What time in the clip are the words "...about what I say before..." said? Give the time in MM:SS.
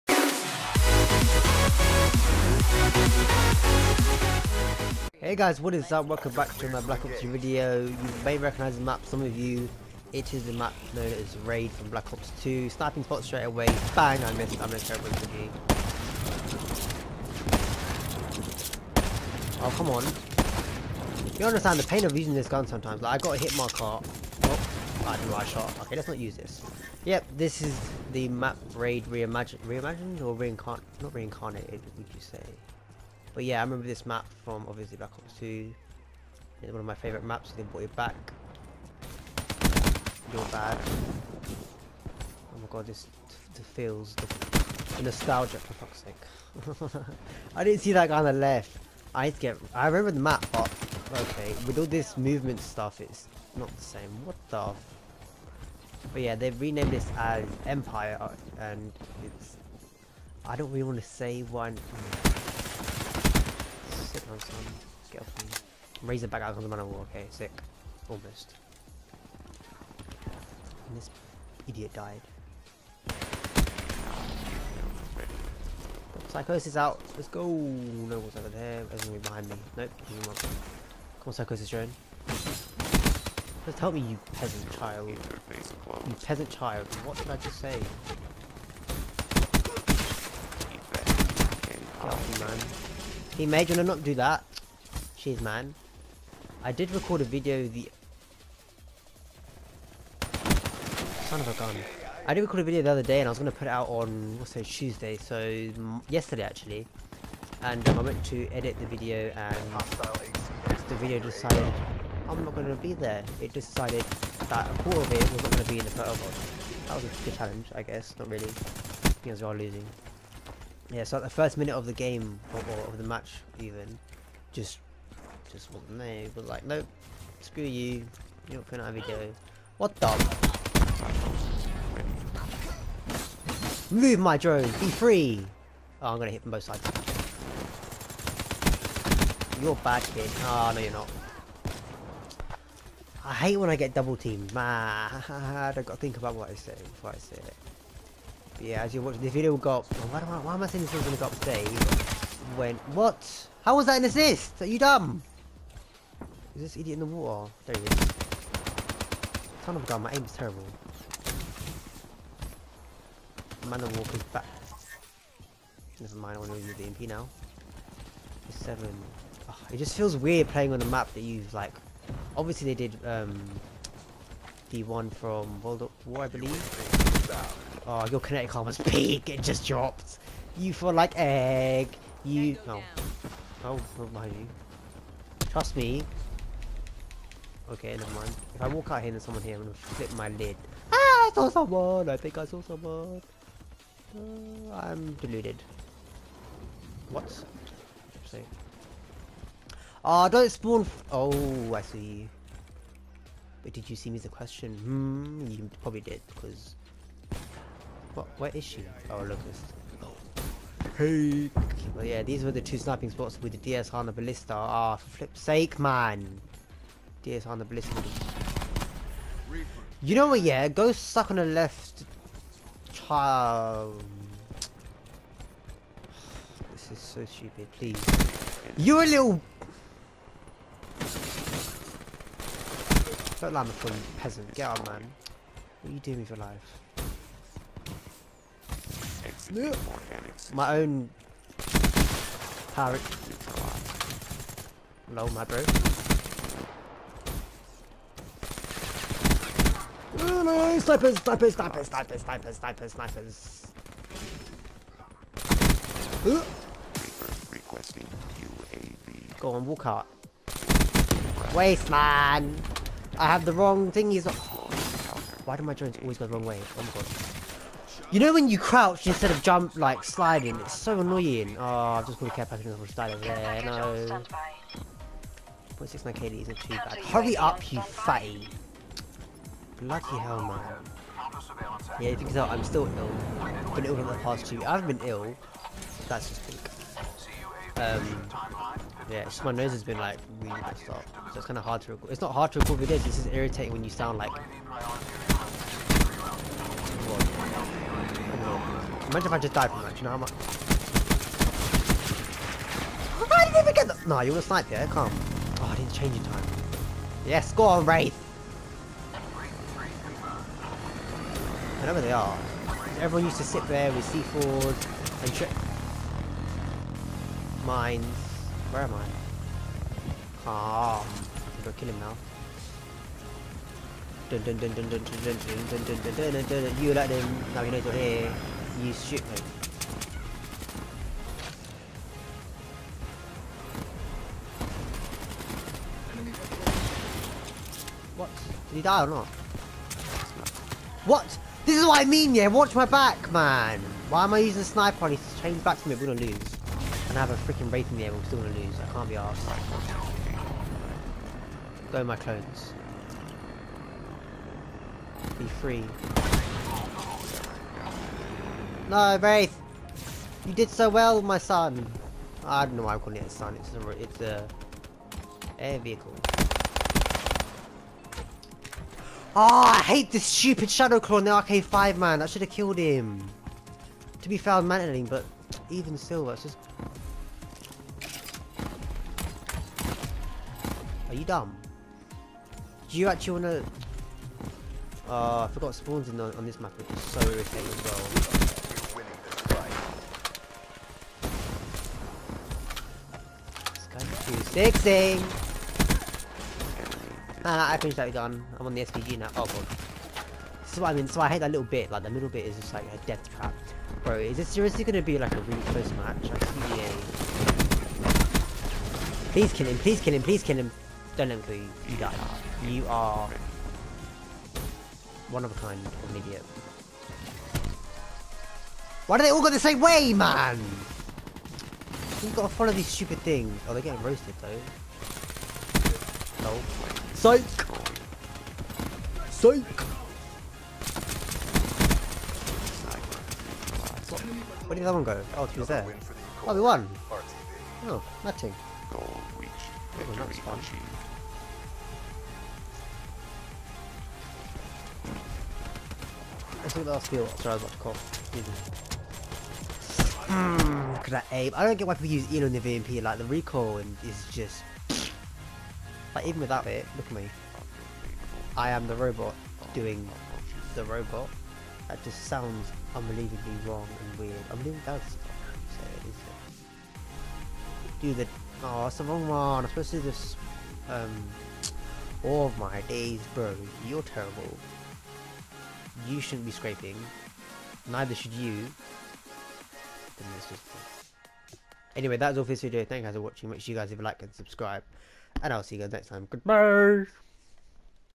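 02:26.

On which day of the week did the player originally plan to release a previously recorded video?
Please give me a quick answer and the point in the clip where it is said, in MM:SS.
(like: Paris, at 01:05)
Tuesday, at 01:44.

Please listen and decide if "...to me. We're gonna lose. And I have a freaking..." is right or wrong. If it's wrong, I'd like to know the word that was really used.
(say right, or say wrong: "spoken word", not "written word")
right.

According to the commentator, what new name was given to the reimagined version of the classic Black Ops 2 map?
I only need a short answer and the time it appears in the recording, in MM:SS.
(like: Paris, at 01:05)
Empire, at 00:57.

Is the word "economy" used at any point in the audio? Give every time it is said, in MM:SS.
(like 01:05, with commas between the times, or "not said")
not said.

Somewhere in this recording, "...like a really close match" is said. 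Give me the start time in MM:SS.
06:45.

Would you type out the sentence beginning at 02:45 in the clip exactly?
Never mind, I want to use the MP now.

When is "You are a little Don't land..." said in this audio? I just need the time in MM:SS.
03:48.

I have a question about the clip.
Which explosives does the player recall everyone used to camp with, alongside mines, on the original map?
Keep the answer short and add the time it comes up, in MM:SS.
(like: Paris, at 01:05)
C4s, at 05:14.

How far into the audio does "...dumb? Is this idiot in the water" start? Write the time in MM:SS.
02:34.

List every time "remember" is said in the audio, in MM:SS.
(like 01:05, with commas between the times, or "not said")
00:33, 00:49.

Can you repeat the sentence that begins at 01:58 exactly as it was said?
Not really, because we are losing.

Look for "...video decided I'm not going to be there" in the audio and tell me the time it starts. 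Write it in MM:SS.
01:50.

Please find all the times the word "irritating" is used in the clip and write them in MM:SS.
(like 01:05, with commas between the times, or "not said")
04:53, 06:27.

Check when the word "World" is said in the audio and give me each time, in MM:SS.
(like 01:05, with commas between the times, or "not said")
02:55.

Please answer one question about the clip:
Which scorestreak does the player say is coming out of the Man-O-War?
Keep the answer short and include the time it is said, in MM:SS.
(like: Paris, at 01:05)
Razorback, at 01:06.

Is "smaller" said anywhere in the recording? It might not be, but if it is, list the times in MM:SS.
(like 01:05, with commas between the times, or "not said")
not said.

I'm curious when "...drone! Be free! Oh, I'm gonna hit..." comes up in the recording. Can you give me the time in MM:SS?
02:14.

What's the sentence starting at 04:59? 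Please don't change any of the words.
Imagine if I just died from that, you know how much...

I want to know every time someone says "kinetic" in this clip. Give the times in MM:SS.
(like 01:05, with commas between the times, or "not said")
02:58.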